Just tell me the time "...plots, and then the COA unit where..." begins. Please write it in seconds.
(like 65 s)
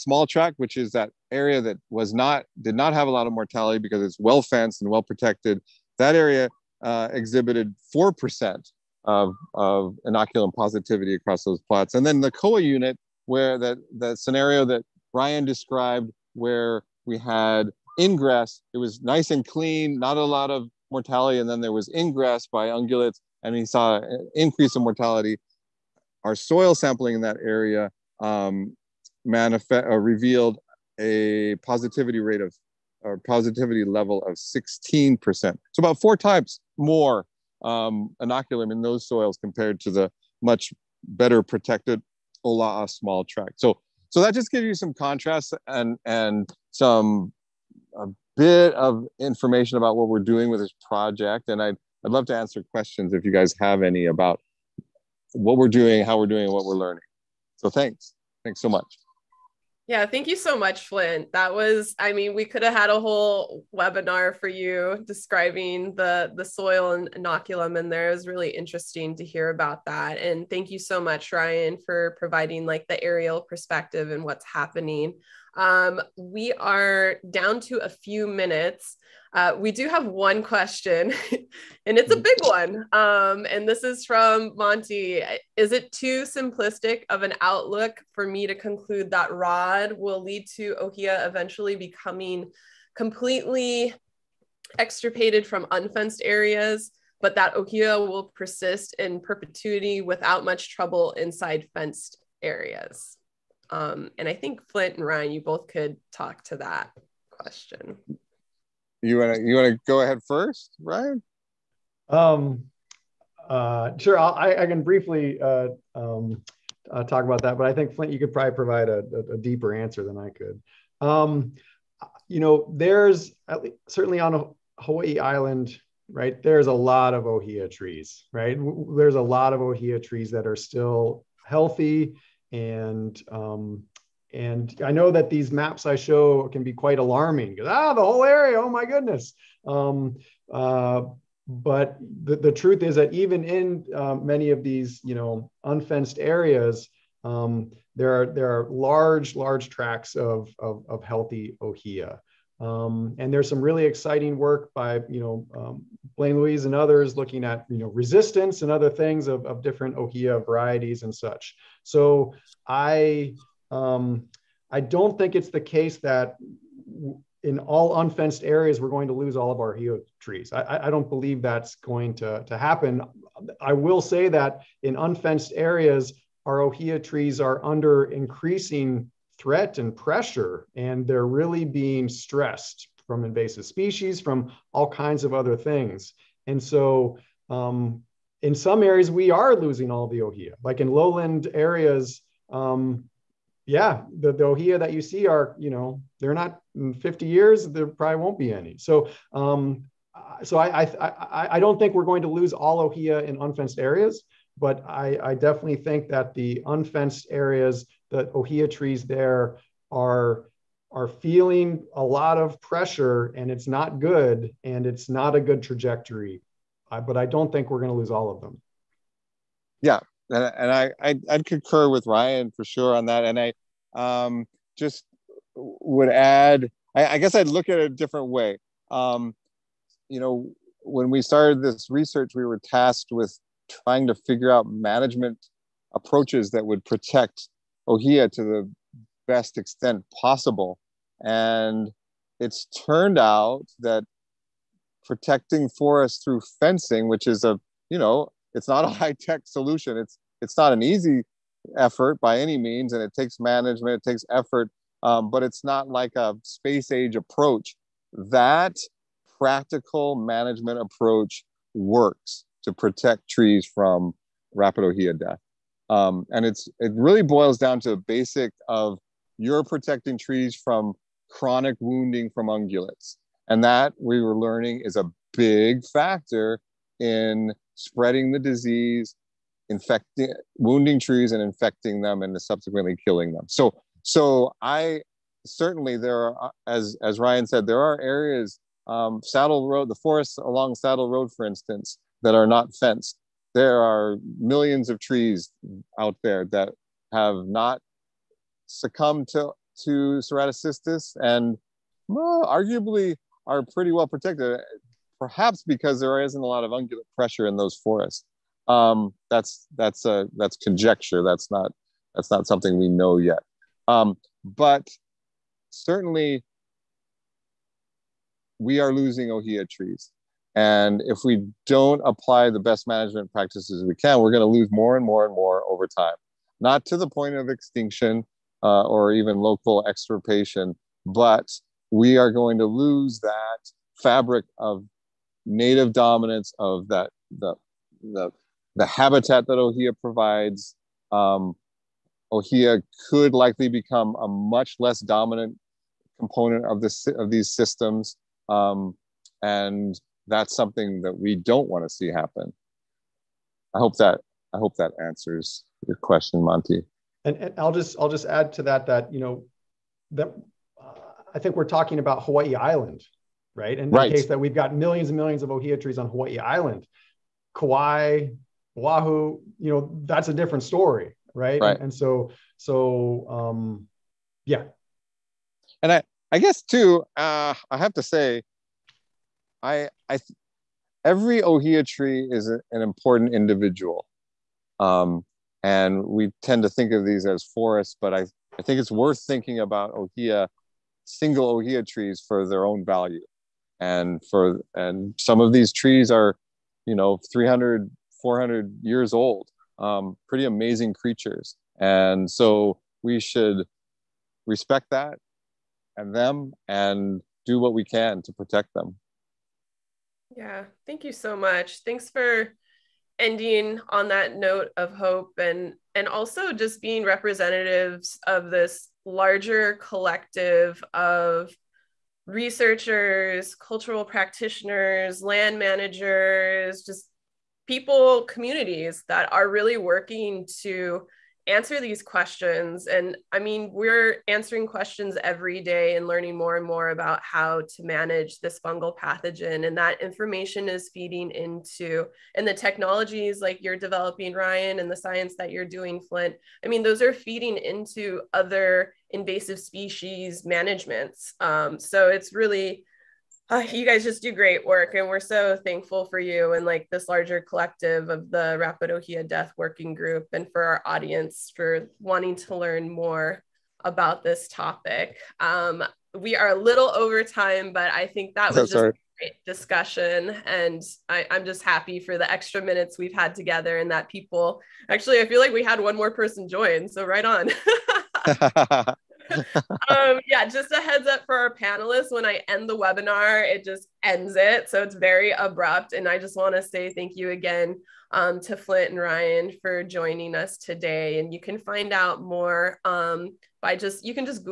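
11 s.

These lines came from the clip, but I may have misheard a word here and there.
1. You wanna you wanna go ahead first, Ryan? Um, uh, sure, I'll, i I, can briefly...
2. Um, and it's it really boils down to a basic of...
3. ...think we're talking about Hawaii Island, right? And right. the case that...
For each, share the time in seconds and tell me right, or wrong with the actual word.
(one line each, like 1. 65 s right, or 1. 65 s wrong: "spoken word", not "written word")
1. 109 s right
2. 265 s right
3. 361 s right.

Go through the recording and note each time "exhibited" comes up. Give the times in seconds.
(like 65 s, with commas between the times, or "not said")
7 s.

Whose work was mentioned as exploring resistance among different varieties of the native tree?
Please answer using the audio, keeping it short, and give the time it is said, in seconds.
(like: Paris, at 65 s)
Blaine Luiz, at 156 s.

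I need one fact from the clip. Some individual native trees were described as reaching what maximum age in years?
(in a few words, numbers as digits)
400 years.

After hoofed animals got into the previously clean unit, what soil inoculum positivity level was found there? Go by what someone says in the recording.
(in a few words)
16%.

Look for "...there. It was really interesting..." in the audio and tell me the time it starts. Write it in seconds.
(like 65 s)
67 s.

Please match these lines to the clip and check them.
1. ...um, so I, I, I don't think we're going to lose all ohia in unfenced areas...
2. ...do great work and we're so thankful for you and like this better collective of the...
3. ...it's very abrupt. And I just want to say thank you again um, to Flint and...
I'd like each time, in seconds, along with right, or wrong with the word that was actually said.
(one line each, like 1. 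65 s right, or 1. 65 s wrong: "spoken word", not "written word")
1. 199 s right
2. 454 s wrong: "larger", not "better"
3. 484 s right.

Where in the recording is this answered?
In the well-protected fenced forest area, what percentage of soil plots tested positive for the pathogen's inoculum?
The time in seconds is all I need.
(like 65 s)
7 s.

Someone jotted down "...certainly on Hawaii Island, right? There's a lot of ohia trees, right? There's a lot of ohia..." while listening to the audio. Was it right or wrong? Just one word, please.
right.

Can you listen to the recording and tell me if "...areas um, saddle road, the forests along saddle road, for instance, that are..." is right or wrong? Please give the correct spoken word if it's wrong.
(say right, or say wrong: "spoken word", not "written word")
right.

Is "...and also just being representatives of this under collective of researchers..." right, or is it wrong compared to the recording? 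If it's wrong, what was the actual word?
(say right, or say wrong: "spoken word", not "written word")
wrong: "larger", not "under".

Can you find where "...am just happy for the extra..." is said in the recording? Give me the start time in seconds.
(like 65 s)
471 s.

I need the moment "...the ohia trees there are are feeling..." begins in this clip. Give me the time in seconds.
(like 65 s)
208 s.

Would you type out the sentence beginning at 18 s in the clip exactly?
It was nice and clean, not a lot of mortality.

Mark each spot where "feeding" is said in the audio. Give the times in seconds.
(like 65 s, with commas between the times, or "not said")
440 s, 447 s.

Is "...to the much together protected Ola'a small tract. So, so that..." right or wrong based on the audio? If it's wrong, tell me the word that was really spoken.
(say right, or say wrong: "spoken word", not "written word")
wrong: "better", not "together".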